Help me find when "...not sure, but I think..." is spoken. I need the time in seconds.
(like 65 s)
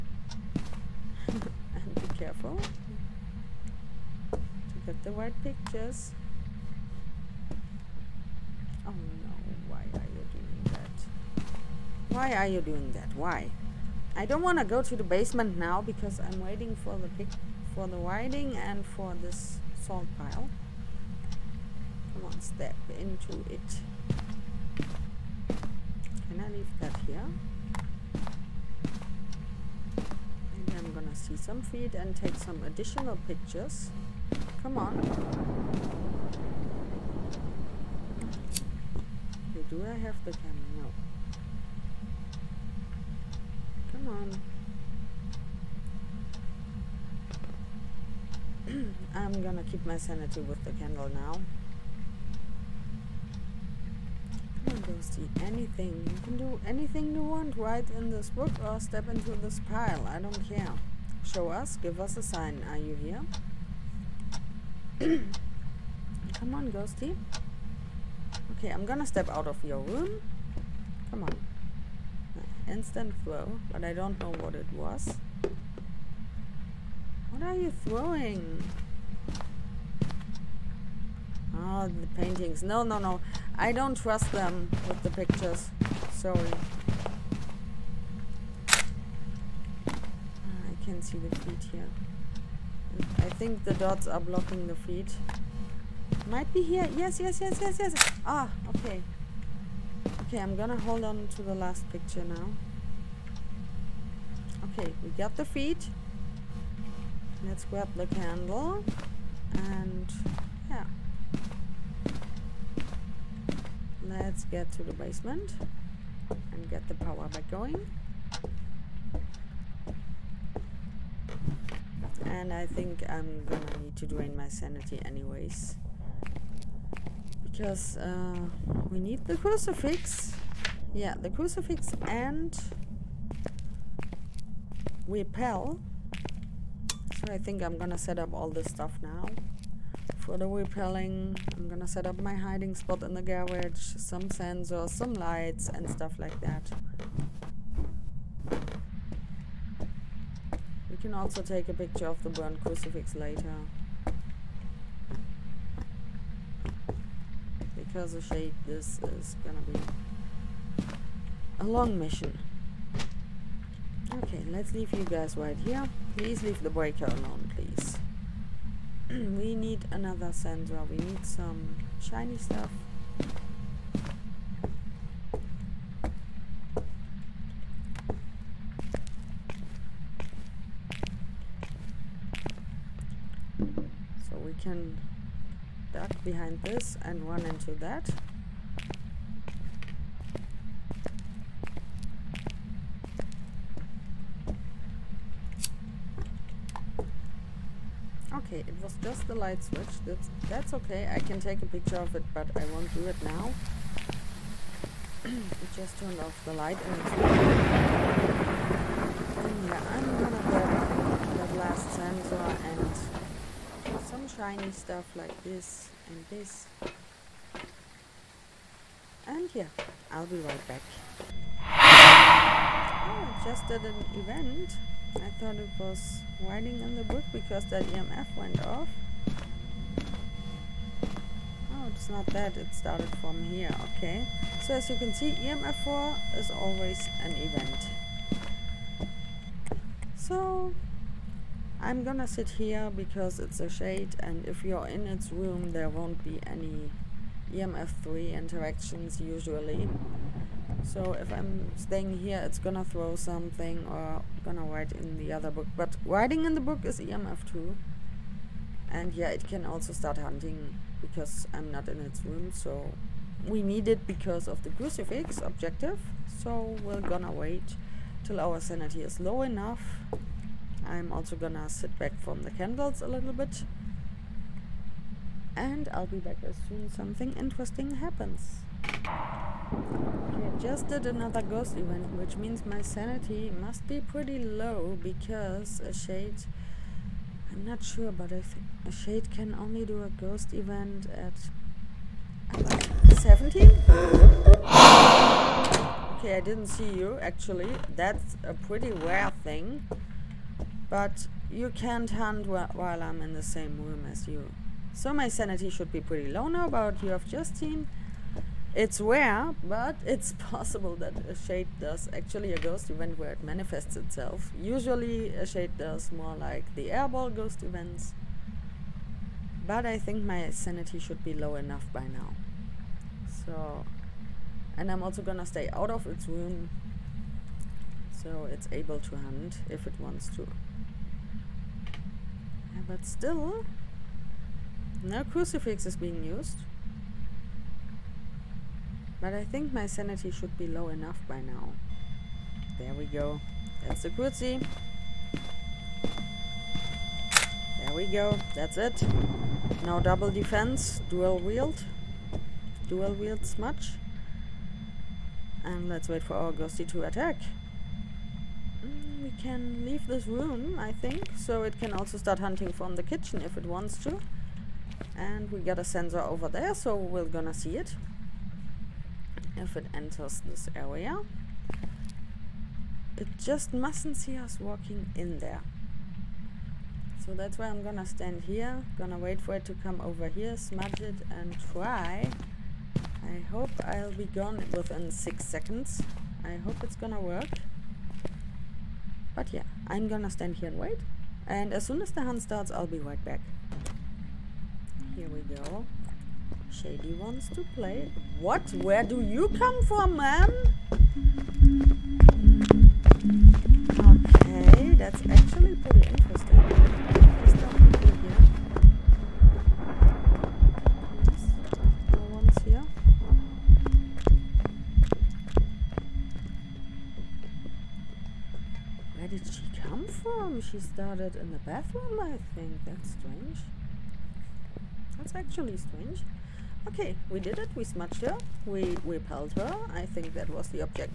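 287 s.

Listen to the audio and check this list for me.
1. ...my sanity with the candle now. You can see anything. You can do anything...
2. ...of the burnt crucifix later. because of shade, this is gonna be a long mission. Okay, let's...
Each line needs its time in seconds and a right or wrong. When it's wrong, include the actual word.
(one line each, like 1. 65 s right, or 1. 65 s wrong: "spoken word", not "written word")
1. 49 s right
2. 152 s right.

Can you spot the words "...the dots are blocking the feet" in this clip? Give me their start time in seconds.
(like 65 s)
93 s.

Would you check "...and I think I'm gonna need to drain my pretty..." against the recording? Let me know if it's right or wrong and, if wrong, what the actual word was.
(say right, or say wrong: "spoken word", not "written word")
wrong: "sanity", not "pretty".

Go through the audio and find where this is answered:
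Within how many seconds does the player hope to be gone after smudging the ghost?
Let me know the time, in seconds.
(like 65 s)
385 s.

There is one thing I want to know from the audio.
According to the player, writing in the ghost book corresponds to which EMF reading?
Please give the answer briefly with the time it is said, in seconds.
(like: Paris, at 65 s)
EMF 2, at 256 s.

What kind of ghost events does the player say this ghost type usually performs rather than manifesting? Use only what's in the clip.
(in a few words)
airball ghost events.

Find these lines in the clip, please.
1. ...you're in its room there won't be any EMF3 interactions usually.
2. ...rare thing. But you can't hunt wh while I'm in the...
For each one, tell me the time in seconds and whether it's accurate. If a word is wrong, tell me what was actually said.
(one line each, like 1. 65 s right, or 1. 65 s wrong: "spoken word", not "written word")
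1. 244 s right
2. 298 s right.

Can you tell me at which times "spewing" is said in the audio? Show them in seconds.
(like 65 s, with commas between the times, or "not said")
not said.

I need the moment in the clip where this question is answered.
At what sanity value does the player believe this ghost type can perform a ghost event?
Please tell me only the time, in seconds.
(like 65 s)
293 s.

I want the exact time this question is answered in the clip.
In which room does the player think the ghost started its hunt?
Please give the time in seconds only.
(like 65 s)
421 s.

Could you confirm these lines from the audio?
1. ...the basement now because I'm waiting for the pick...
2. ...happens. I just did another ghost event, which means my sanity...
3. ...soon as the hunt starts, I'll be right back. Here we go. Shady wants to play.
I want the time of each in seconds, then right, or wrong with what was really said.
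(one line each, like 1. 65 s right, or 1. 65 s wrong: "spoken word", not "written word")
1. 14 s right
2. 277 s right
3. 391 s right.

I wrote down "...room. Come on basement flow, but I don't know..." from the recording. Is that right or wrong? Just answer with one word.
wrong.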